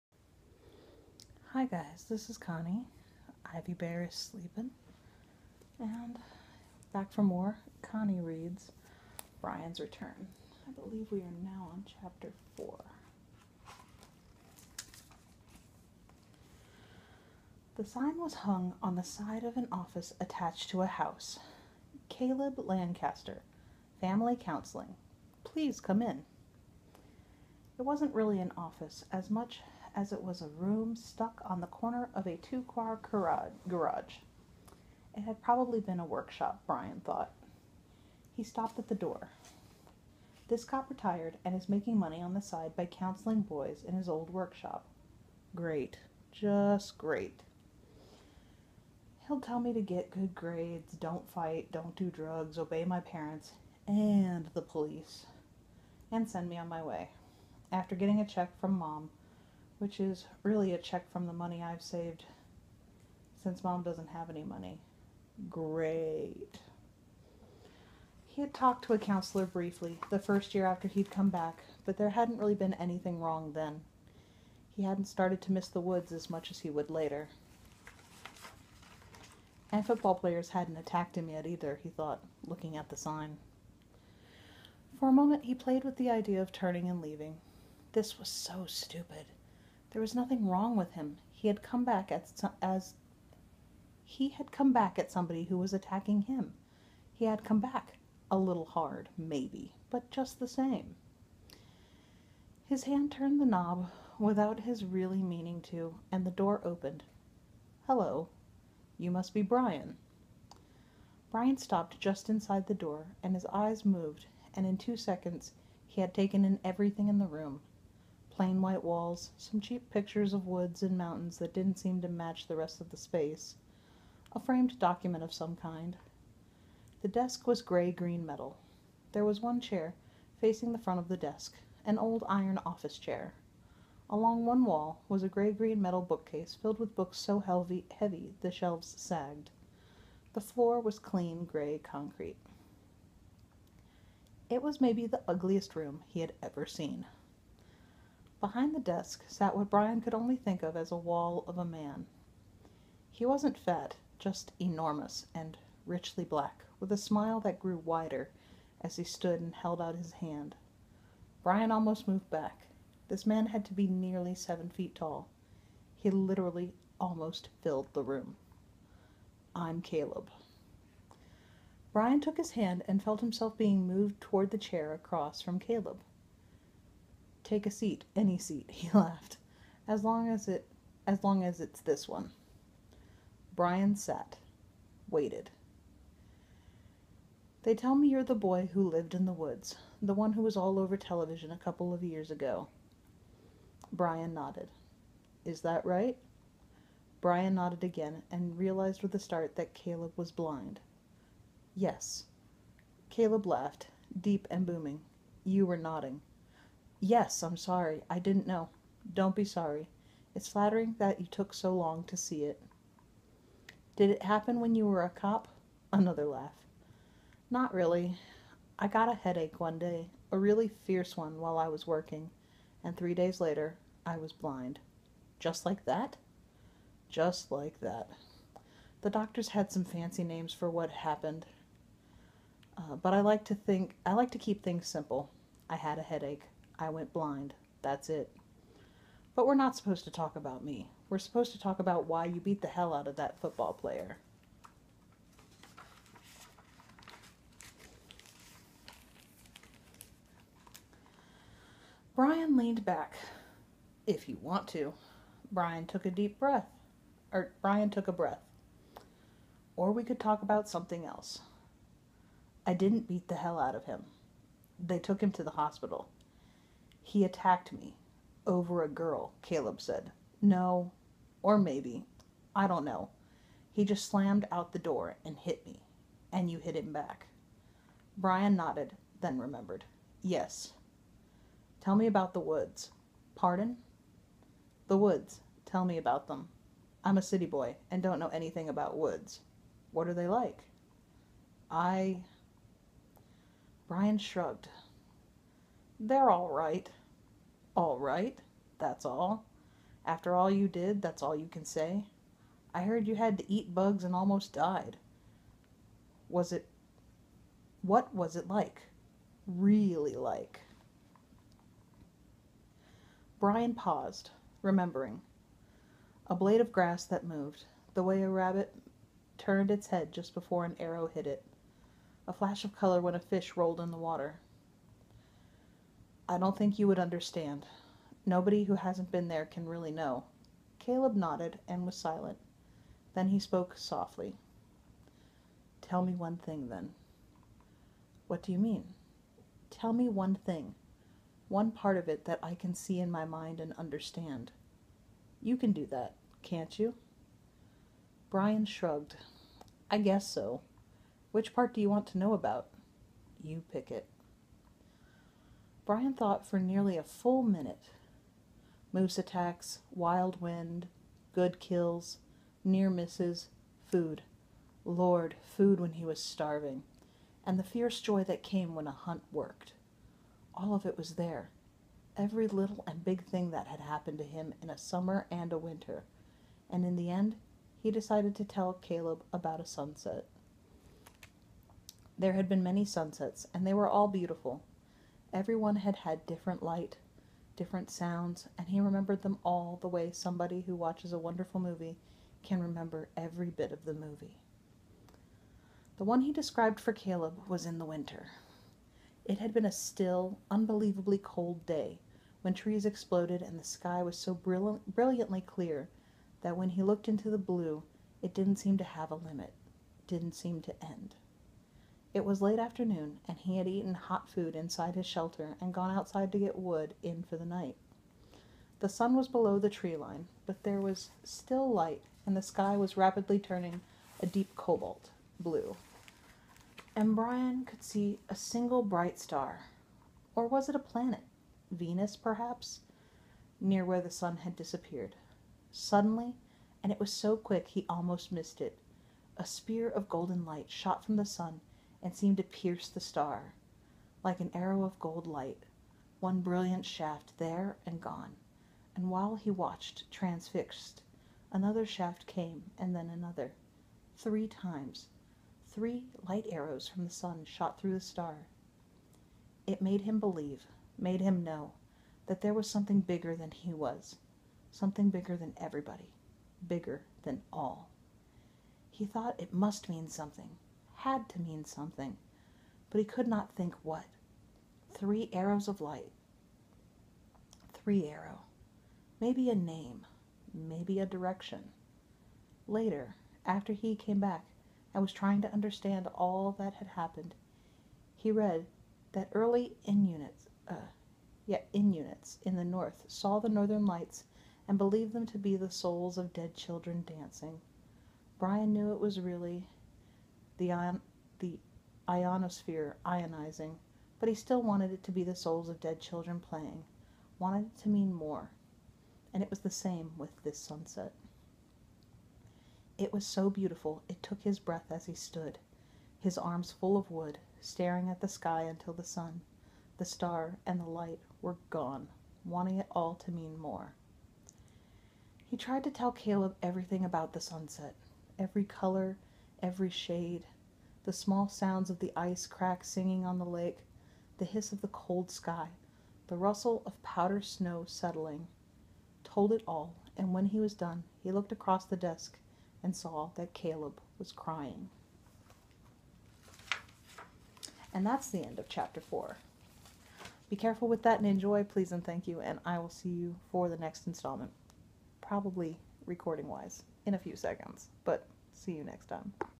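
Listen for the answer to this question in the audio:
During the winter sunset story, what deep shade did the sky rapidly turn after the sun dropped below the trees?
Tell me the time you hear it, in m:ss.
7:04.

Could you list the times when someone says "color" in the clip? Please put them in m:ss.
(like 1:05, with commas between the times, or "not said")
5:22, 8:48.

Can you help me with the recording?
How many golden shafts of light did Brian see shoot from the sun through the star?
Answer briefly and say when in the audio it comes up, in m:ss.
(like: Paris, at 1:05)
3, at 7:34.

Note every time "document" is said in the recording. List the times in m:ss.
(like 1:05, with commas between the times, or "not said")
2:04.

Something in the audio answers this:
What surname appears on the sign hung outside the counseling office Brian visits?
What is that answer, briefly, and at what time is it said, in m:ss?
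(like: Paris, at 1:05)
Lancaster, at 0:22.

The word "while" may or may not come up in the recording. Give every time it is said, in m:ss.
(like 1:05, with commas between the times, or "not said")
3:41, 7:29.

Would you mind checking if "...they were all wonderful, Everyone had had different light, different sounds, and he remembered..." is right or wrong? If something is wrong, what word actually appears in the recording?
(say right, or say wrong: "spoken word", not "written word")
wrong: "beautiful", not "wonderful".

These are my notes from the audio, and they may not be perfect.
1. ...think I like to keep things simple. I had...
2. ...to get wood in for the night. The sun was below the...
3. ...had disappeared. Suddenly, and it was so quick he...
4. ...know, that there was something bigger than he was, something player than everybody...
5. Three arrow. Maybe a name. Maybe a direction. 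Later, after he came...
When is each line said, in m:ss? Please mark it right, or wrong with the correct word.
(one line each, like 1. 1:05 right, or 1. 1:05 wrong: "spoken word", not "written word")
1. 3:53 right
2. 6:56 right
3. 7:14 right
4. 7:41 wrong: "bigger", not "player"
5. 7:57 right.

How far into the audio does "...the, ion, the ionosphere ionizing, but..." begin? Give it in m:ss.
8:20.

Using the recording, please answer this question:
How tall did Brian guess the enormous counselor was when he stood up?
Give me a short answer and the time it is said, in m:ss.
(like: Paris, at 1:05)
Nearly seven feet, at 2:44.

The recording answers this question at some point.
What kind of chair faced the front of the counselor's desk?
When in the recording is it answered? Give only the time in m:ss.
2:11.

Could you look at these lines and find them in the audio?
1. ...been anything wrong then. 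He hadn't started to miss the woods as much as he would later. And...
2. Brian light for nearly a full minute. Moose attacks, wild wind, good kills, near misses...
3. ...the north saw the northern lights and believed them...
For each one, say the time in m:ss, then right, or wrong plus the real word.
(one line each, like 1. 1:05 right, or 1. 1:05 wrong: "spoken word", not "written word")
1. 1:12 right
2. 5:55 wrong: "thought", not "light"
3. 8:12 right.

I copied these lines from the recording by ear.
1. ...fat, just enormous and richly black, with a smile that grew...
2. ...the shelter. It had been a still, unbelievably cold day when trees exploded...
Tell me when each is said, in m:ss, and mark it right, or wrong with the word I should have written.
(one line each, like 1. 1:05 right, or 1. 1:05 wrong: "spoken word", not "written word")
1. 2:33 right
2. 6:37 wrong: "winter", not "shelter".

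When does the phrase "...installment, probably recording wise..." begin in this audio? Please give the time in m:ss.
9:14.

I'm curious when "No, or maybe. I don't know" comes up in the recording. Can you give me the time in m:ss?
4:30.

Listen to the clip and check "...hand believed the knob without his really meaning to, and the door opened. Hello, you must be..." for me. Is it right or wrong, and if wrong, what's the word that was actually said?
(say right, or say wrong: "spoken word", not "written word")
wrong: "turned", not "believed".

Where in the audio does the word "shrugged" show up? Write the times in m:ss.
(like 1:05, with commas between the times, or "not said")
4:54, 5:48.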